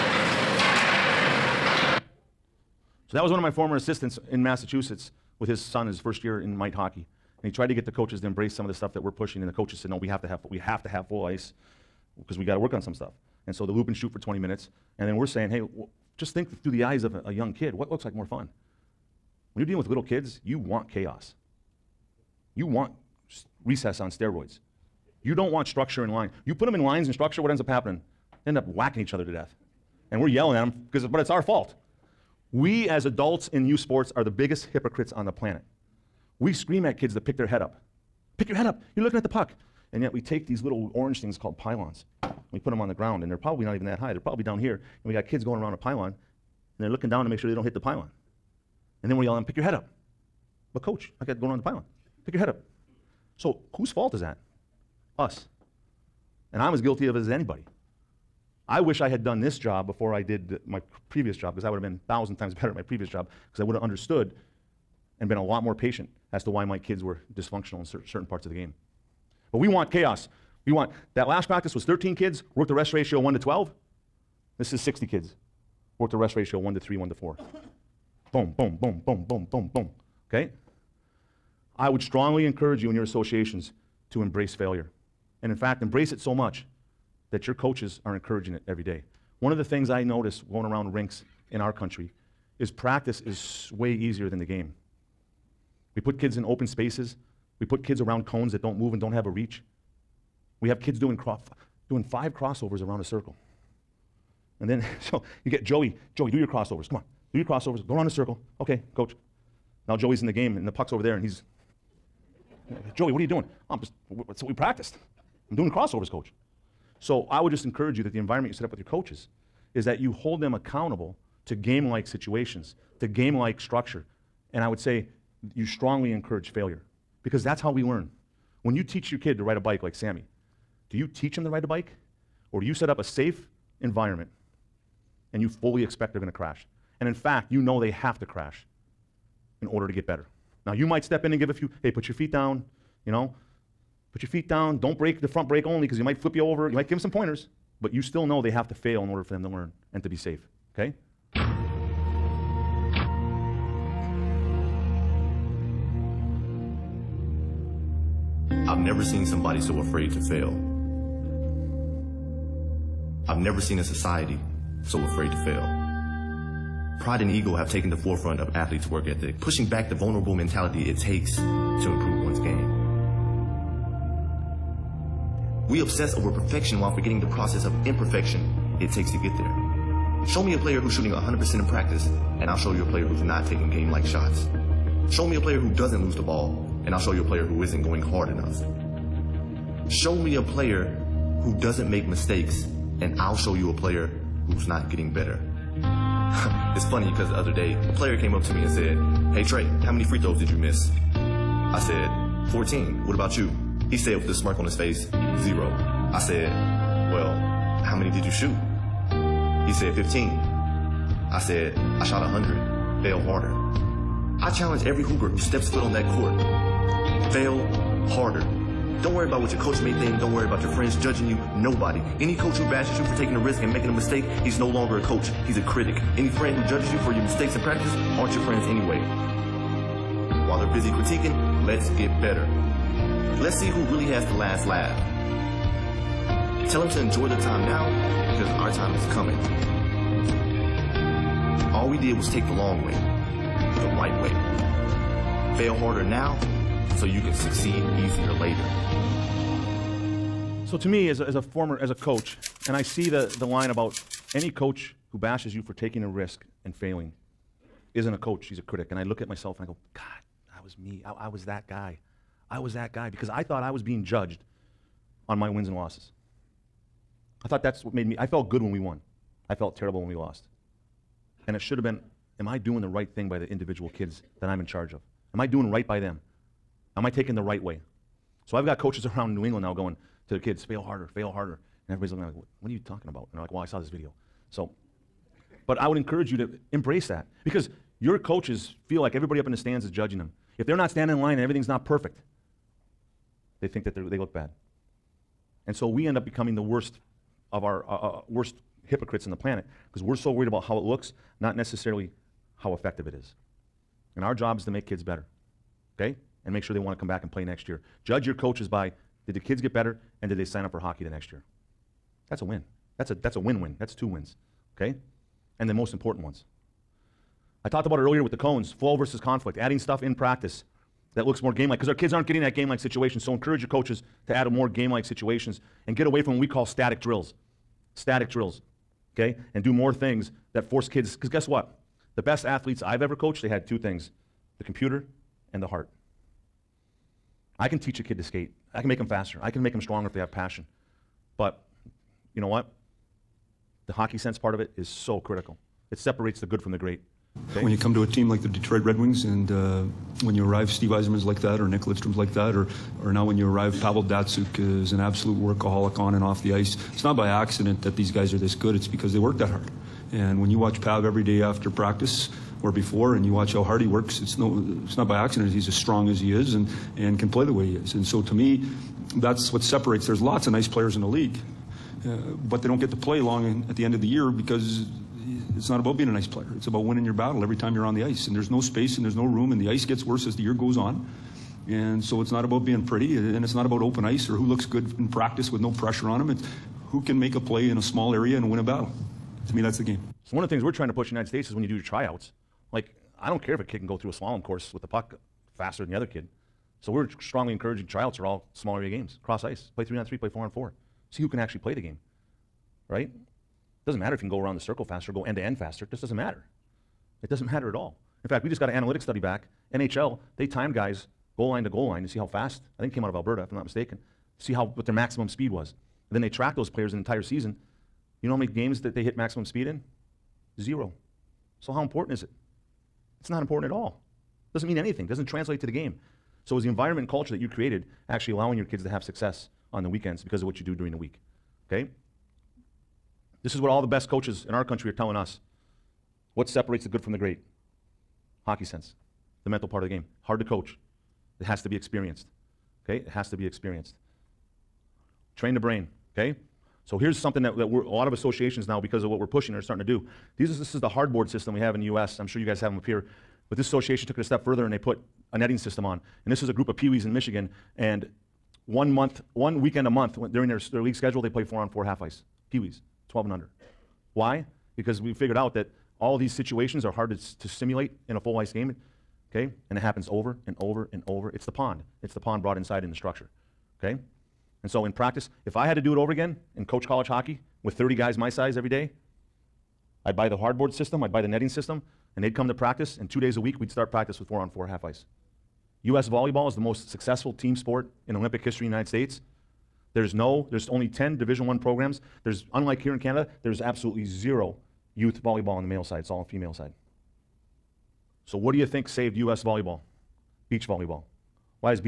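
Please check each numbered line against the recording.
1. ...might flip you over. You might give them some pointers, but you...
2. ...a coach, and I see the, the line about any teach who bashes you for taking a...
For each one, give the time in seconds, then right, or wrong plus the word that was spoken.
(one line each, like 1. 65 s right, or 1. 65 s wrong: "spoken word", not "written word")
1. 146 s right
2. 251 s wrong: "coach", not "teach".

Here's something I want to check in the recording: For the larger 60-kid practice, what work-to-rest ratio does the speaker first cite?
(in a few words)
1 to 3.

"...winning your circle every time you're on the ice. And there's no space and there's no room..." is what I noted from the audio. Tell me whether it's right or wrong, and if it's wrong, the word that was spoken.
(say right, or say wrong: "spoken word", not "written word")
wrong: "battle", not "circle".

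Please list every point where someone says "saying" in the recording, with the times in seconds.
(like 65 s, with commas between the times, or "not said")
15 s.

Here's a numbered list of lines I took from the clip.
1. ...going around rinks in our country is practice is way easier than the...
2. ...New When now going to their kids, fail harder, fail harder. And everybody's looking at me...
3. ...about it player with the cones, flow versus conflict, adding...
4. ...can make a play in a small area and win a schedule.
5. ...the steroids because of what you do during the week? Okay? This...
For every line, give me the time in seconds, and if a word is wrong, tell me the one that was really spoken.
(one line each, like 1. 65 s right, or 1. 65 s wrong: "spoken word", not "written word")
1. 90 s right
2. 279 s wrong: "England", not "When"
3. 317 s wrong: "earlier", not "player"
4. 387 s wrong: "battle", not "schedule"
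5. 429 s wrong: "weekends", not "steroids".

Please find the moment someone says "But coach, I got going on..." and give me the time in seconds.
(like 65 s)
50 s.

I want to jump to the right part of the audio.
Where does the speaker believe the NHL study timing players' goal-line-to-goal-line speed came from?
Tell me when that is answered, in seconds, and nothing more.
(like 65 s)
413 s.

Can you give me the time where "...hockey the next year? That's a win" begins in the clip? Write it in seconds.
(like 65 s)
310 s.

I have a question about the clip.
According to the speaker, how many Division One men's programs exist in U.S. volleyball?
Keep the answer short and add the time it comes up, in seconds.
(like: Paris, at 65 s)
10, at 490 s.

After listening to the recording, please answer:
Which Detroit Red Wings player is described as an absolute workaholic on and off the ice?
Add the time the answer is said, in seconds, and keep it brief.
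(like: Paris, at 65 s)
Pavel Datsyuk, at 353 s.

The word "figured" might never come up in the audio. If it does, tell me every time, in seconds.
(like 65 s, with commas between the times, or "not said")
465 s.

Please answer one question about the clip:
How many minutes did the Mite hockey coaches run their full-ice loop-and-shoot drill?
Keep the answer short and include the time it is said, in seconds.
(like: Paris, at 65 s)
20, at 14 s.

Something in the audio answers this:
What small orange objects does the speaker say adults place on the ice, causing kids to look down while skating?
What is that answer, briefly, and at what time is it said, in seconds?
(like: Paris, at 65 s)
pylons, at 41 s.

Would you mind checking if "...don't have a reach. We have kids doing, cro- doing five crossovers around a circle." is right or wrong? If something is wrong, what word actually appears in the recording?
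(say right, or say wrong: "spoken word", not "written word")
right.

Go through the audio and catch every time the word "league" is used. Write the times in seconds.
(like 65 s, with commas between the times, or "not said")
371 s, 460 s.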